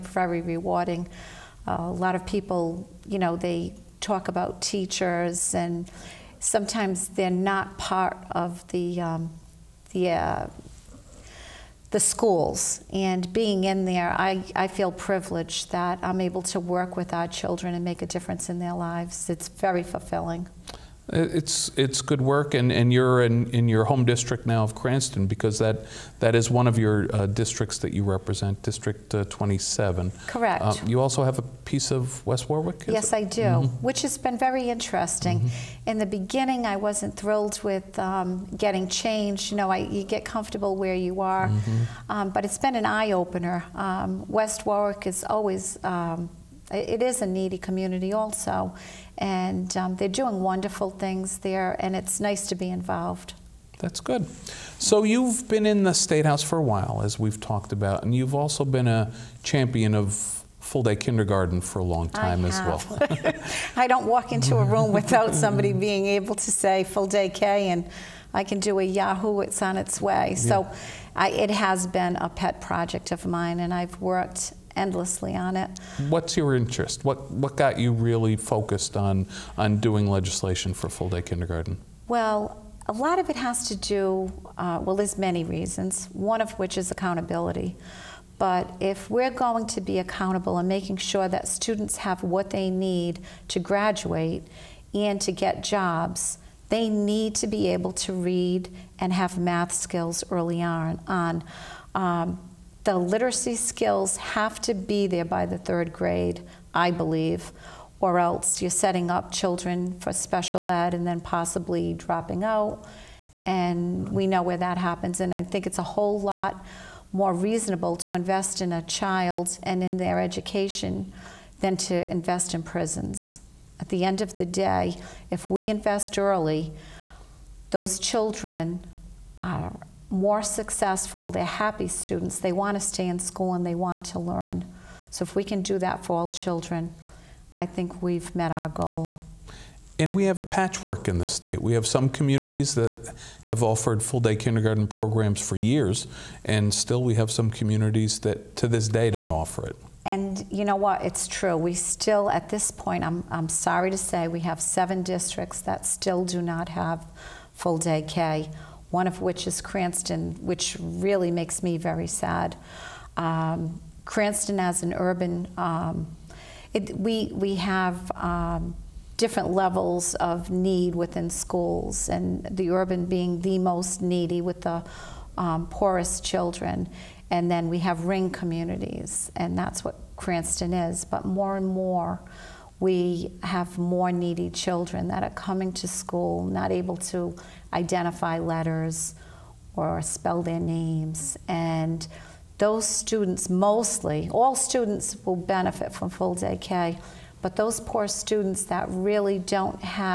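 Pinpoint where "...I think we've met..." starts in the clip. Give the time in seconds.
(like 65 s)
137 s.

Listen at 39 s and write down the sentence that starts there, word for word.
You know, I, you get comfortable where you are, mm-hmm.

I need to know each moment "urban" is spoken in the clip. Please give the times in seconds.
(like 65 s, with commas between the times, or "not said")
164 s, 172 s.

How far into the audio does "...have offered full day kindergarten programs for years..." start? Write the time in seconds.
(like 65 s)
143 s.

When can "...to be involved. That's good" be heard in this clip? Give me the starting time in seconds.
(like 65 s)
52 s.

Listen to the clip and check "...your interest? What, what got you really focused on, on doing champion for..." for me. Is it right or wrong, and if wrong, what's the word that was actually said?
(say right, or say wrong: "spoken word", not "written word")
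wrong: "legislation", not "champion".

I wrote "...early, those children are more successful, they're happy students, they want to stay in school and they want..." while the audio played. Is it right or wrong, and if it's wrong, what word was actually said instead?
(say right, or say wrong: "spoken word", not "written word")
right.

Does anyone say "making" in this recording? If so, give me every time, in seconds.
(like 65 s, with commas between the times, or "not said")
90 s.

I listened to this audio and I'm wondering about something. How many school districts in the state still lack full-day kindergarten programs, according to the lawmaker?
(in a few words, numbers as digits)
7.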